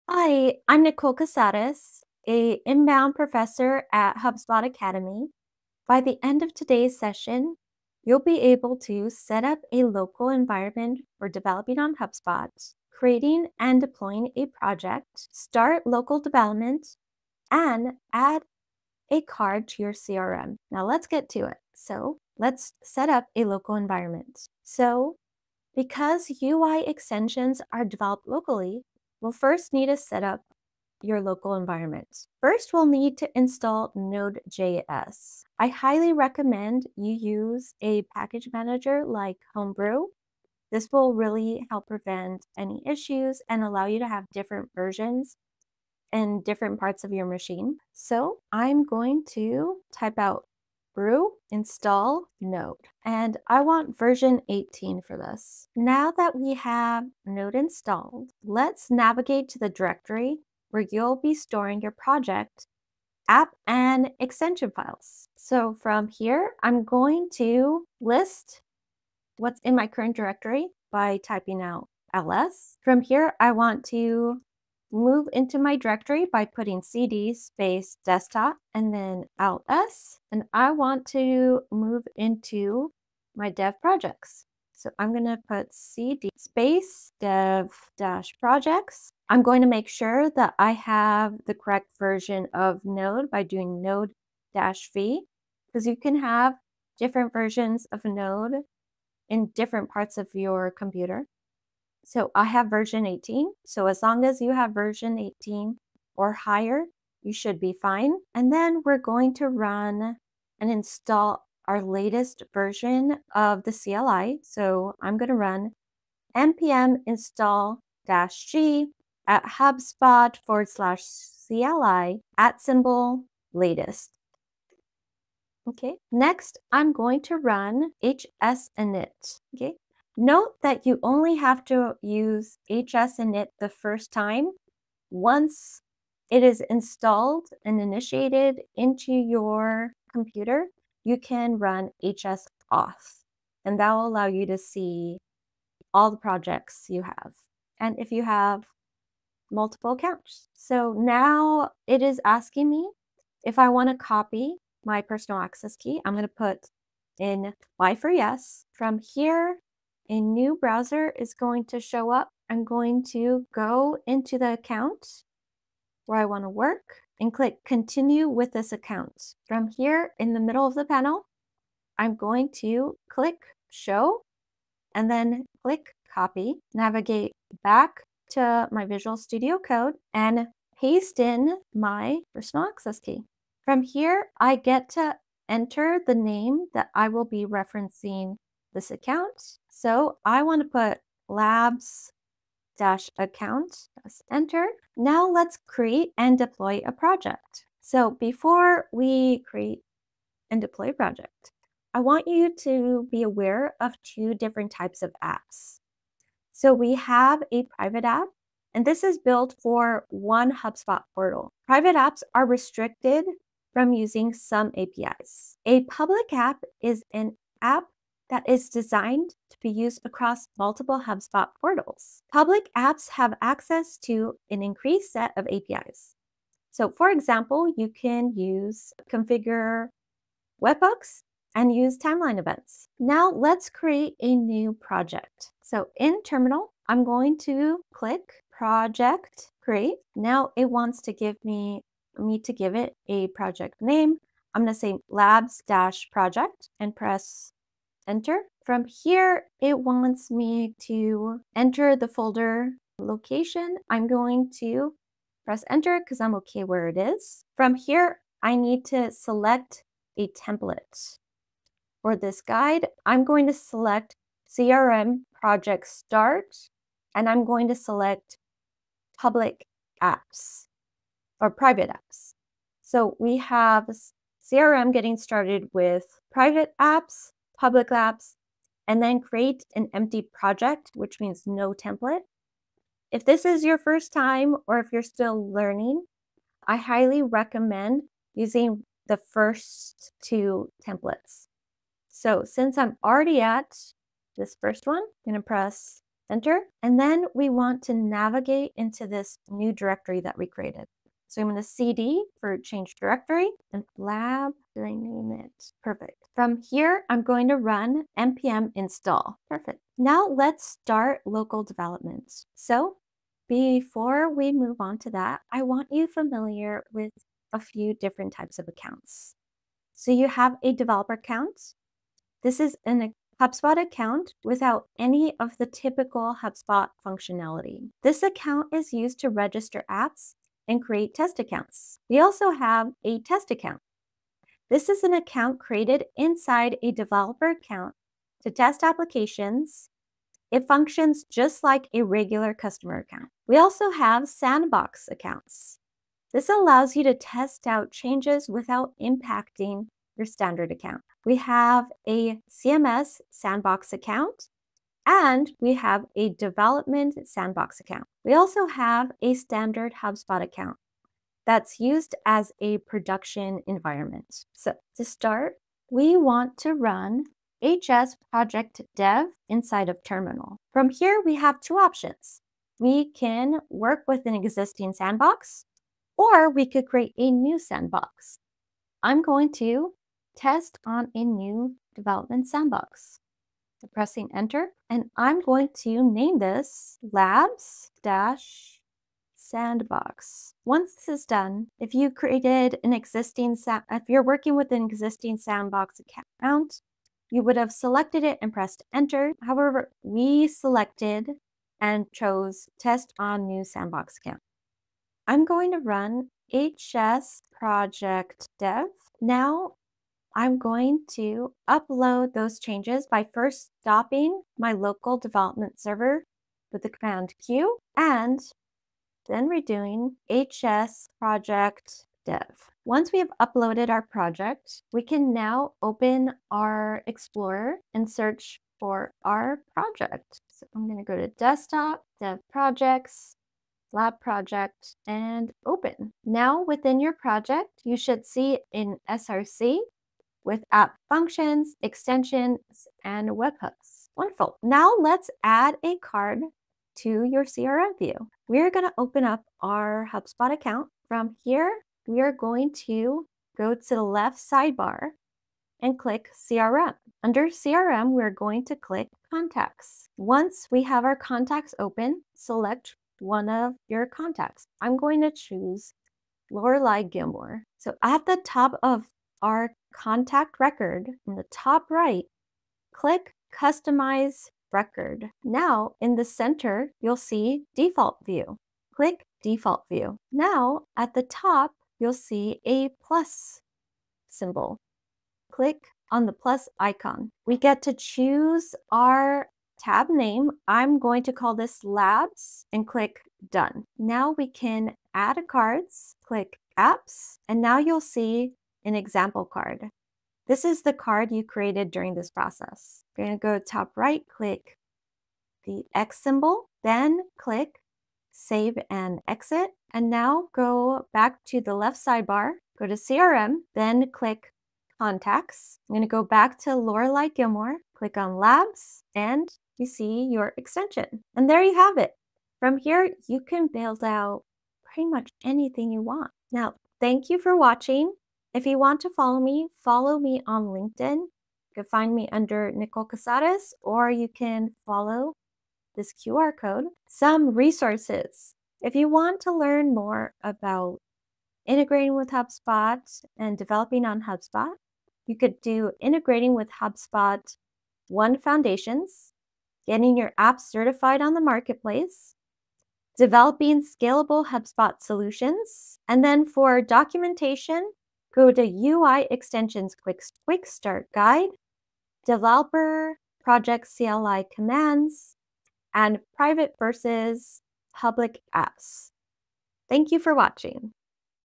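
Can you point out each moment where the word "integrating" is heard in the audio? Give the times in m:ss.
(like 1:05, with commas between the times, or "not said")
9:01, 9:06.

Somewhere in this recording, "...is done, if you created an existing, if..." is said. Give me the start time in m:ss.
6:31.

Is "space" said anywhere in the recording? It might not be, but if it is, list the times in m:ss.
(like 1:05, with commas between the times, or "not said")
1:17, 1:26.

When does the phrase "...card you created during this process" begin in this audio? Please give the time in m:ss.
8:20.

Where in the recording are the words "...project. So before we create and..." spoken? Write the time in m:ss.
3:16.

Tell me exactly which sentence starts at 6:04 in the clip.
So to start, we want to run HS project dev inside of terminal.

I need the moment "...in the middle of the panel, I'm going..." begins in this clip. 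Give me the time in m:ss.
2:50.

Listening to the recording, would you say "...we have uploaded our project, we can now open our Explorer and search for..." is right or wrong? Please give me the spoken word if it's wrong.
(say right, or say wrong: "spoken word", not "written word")
right.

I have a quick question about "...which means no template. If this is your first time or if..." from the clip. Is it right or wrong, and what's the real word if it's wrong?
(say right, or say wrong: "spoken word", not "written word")
right.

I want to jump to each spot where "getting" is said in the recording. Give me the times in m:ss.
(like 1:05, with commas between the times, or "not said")
4:34, 9:09.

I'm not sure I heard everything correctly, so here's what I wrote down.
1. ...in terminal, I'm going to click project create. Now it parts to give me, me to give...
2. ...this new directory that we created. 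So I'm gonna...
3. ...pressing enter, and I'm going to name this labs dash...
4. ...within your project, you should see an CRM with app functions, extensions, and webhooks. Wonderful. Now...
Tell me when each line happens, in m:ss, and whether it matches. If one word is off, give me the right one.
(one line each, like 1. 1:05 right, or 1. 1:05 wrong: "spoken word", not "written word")
1. 3:55 wrong: "wants", not "parts"
2. 4:59 right
3. 6:23 right
4. 7:16 wrong: "SRC", not "CRM".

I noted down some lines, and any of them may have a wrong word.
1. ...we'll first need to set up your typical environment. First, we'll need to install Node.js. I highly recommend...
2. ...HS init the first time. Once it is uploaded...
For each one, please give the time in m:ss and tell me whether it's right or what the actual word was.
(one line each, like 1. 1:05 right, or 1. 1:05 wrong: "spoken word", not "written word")
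1. 0:29 wrong: "local", not "typical"
2. 2:12 wrong: "installed", not "uploaded".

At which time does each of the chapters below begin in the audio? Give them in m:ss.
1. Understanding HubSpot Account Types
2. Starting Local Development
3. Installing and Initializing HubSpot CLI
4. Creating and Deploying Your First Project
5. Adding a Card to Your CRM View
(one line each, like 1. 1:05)
1. 5:12
2. 6:04
3. 1:48
4. 3:14
5. 7:24.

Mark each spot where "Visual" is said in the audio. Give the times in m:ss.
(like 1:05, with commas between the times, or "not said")
2:58.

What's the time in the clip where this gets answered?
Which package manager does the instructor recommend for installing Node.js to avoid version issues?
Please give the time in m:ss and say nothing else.
0:39.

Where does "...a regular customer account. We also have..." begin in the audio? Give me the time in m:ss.
5:41.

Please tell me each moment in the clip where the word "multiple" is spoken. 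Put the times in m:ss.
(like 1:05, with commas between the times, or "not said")
2:29, 3:40.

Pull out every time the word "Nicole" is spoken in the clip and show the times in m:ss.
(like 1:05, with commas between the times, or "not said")
0:00, 8:52.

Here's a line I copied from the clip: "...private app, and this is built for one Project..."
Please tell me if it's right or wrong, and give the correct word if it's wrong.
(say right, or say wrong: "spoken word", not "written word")
wrong: "HubSpot", not "Project".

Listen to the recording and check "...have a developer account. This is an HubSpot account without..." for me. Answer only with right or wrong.
right.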